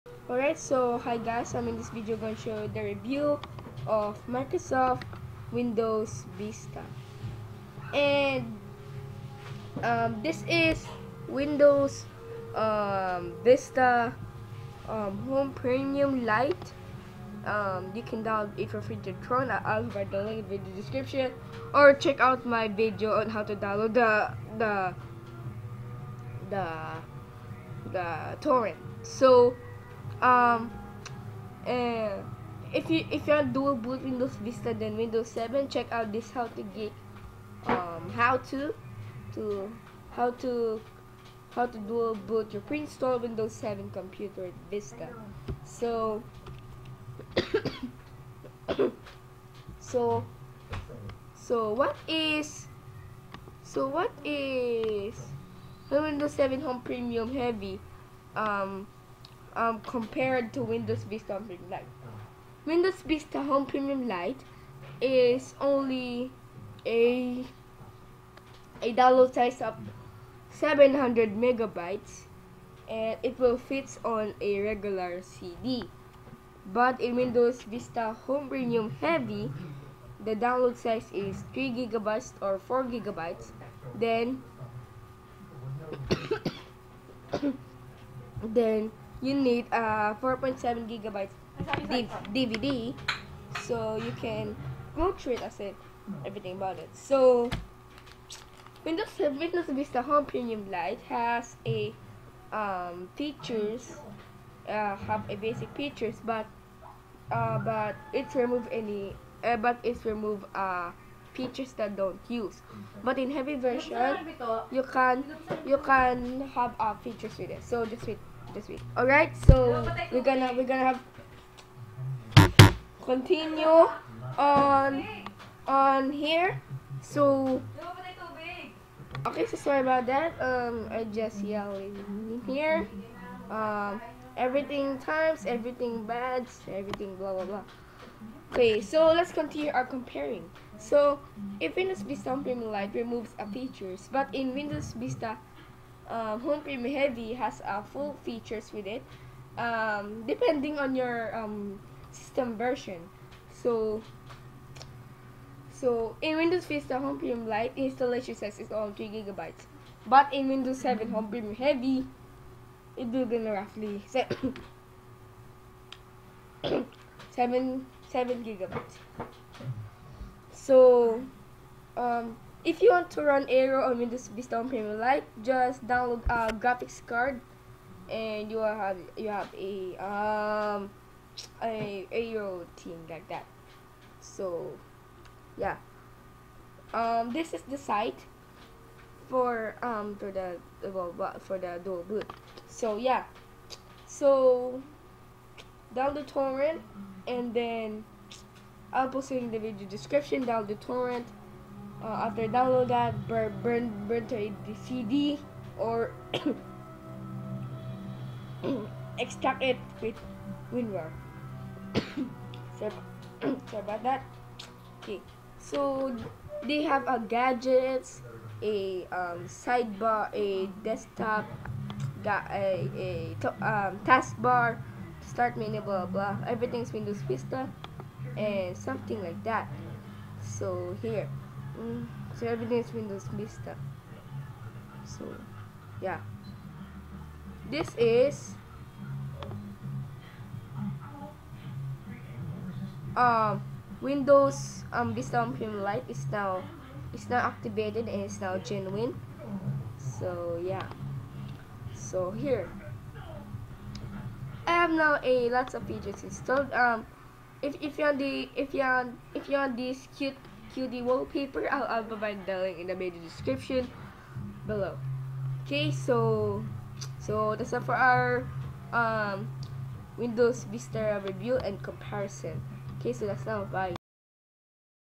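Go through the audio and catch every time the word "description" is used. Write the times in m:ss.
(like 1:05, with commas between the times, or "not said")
0:20, 3:19, 4:23.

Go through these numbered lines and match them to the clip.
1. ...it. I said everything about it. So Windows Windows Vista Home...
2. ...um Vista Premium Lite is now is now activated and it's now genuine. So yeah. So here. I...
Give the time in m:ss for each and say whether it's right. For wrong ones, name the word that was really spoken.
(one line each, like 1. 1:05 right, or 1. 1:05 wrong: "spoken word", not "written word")
1. 1:35 right
2. 4:04 right.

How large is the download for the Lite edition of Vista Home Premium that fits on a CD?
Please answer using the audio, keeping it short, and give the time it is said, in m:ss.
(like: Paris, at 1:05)
700 megabytes, at 1:10.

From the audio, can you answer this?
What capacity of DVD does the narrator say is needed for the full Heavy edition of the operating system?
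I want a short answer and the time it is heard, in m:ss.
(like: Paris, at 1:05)
4.7 gigabytes, at 1:30.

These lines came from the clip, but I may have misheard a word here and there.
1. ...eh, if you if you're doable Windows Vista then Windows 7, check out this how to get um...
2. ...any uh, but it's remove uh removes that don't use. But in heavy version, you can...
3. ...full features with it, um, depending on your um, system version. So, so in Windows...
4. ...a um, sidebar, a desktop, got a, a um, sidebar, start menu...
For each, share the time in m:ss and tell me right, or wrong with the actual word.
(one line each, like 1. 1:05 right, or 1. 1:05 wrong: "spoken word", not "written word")
1. 0:32 right
2. 1:48 wrong: "features", not "removes"
3. 2:27 right
4. 3:38 wrong: "taskbar", not "sidebar".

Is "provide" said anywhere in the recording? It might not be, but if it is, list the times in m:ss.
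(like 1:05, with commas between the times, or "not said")
0:19, 4:22.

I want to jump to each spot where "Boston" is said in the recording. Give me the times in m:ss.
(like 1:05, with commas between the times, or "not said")
not said.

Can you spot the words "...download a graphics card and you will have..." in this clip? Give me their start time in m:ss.
2:55.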